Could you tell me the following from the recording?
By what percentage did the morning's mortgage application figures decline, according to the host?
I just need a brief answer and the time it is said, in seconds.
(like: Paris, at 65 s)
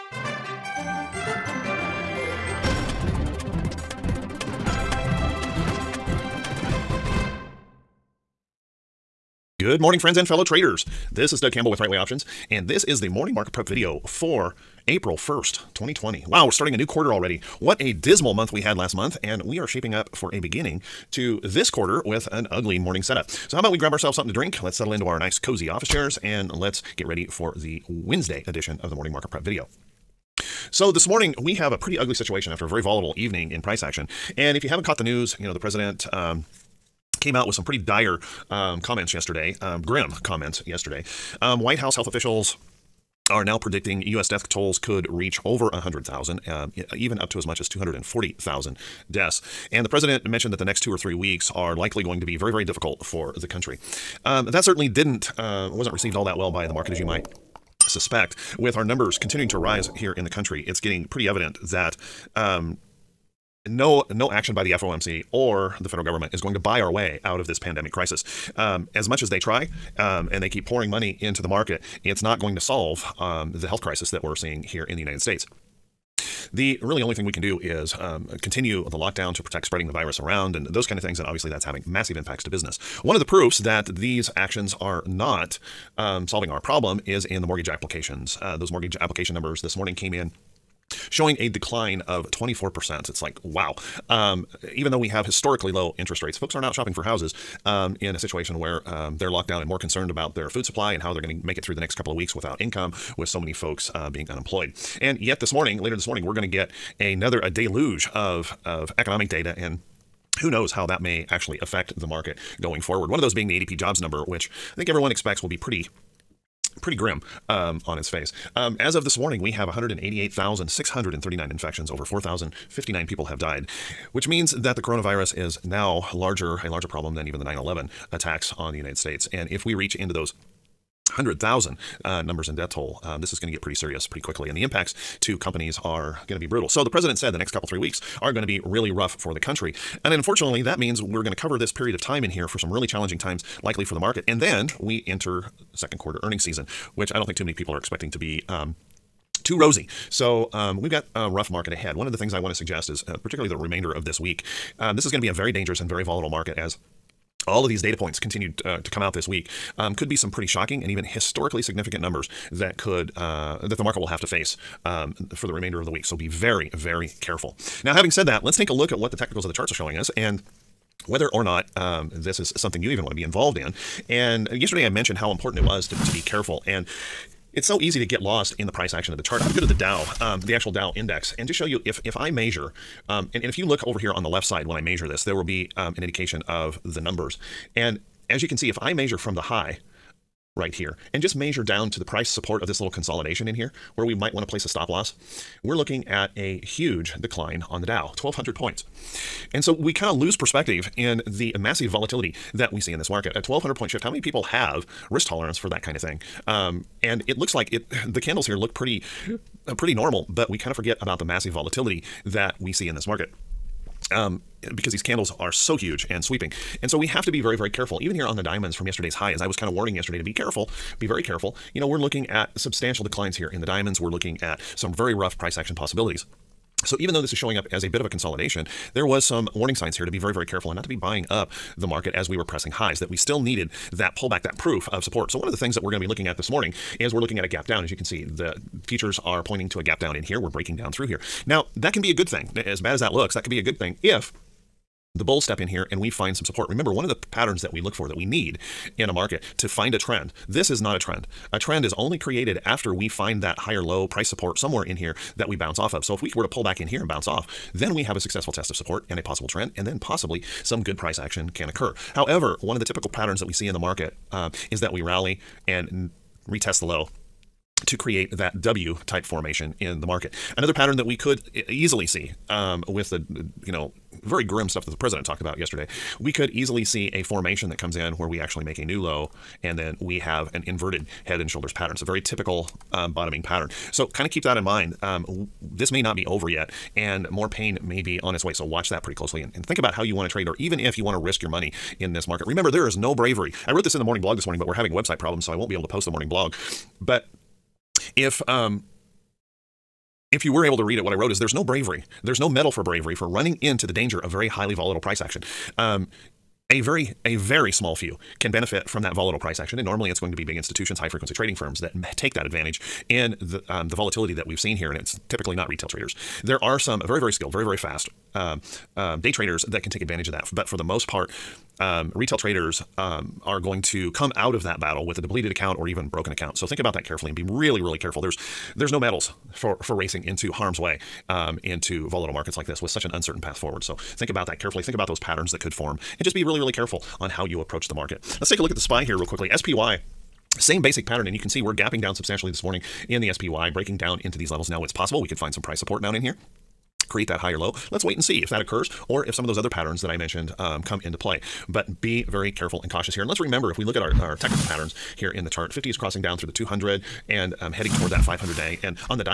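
24%, at 92 s.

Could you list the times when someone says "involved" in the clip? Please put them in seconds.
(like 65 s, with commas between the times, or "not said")
173 s.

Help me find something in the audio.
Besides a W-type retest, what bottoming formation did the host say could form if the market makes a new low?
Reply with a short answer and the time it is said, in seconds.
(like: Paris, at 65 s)
inverted head and shoulders, at 280 s.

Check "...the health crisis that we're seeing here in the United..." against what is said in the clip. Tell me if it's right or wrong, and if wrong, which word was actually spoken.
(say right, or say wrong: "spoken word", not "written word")
right.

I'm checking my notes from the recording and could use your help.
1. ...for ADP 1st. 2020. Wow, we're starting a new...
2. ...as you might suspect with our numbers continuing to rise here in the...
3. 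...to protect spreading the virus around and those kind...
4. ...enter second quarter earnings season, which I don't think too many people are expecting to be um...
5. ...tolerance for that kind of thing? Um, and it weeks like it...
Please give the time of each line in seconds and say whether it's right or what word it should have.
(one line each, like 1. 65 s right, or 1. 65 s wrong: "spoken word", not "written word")
1. 14 s wrong: "April", not "ADP"
2. 56 s right
3. 79 s right
4. 145 s right
5. 205 s wrong: "looks", not "weeks".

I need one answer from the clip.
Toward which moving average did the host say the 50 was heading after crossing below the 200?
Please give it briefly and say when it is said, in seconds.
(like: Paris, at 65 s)
500 day, at 358 s.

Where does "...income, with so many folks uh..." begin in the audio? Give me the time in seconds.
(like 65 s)
102 s.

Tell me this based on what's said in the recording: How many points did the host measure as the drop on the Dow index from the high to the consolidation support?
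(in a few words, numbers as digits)
1,200 points.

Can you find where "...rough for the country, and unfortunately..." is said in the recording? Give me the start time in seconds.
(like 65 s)
138 s.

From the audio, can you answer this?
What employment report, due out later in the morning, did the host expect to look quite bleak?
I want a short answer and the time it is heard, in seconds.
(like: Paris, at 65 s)
ADP jobs number, at 113 s.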